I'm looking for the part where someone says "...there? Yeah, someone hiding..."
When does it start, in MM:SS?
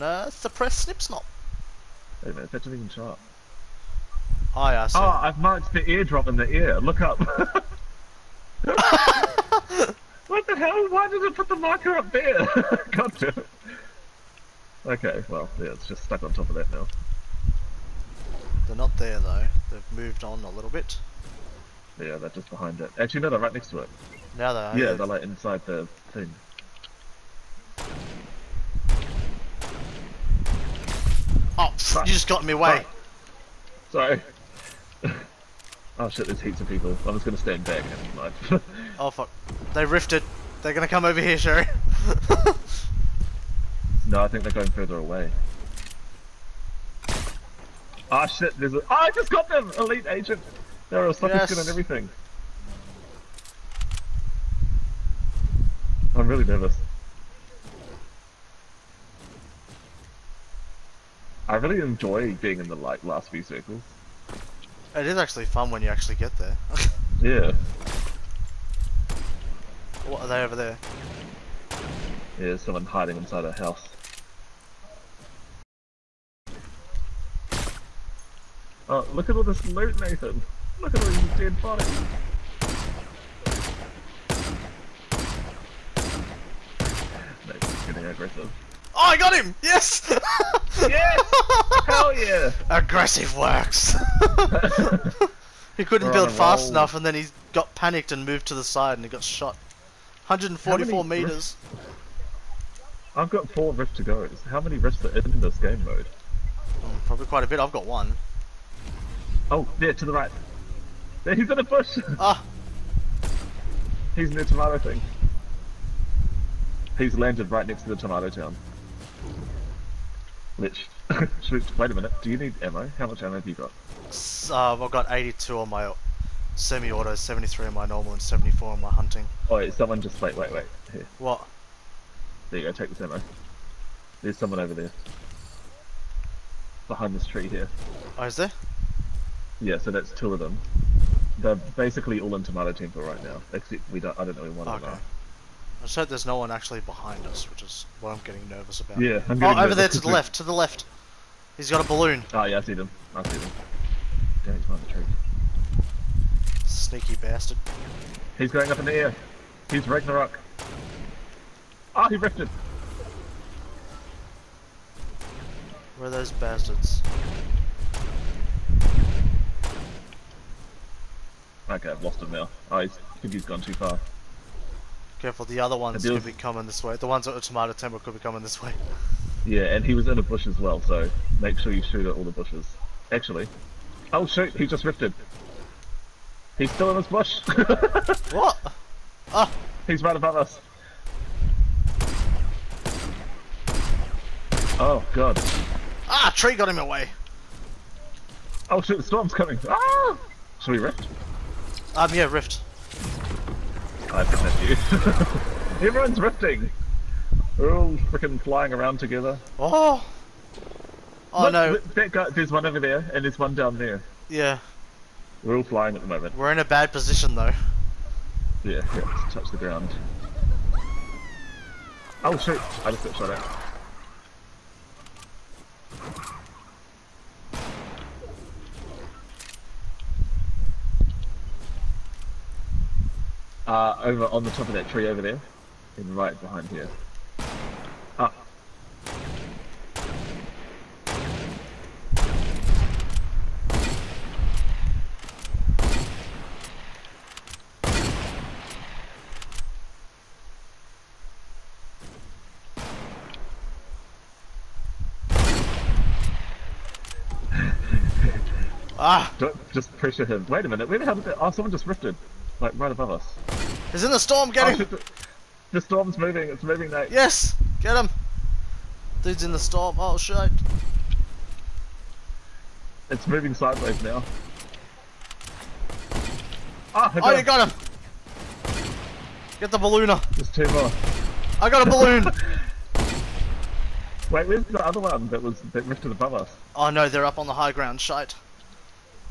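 01:10.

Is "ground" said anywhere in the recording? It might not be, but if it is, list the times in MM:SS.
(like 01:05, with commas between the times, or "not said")
03:39, 04:47.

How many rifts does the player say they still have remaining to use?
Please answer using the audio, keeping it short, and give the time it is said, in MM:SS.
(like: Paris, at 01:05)
4, at 01:43.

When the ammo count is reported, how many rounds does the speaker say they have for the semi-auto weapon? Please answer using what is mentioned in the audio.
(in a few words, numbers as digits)
82.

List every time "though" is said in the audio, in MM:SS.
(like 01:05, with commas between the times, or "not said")
00:19, 03:37.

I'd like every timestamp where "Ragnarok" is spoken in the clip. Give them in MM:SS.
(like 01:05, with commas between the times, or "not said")
02:39.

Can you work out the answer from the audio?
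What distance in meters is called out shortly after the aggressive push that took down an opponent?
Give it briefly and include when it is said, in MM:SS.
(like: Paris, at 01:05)
144 meters, at 01:40.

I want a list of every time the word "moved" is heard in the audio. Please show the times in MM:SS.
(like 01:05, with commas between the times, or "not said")
00:19, 01:38.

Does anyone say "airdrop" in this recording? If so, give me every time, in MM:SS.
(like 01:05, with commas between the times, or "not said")
00:05.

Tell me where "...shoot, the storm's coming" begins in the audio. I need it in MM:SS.
03:18.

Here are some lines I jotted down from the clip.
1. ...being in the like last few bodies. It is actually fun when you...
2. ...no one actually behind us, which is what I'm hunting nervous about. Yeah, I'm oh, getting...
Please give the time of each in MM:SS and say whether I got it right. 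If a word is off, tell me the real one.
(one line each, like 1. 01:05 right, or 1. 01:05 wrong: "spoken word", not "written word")
1. 01:02 wrong: "circles", not "bodies"
2. 02:26 wrong: "getting", not "hunting".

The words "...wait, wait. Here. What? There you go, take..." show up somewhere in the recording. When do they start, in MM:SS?
02:10.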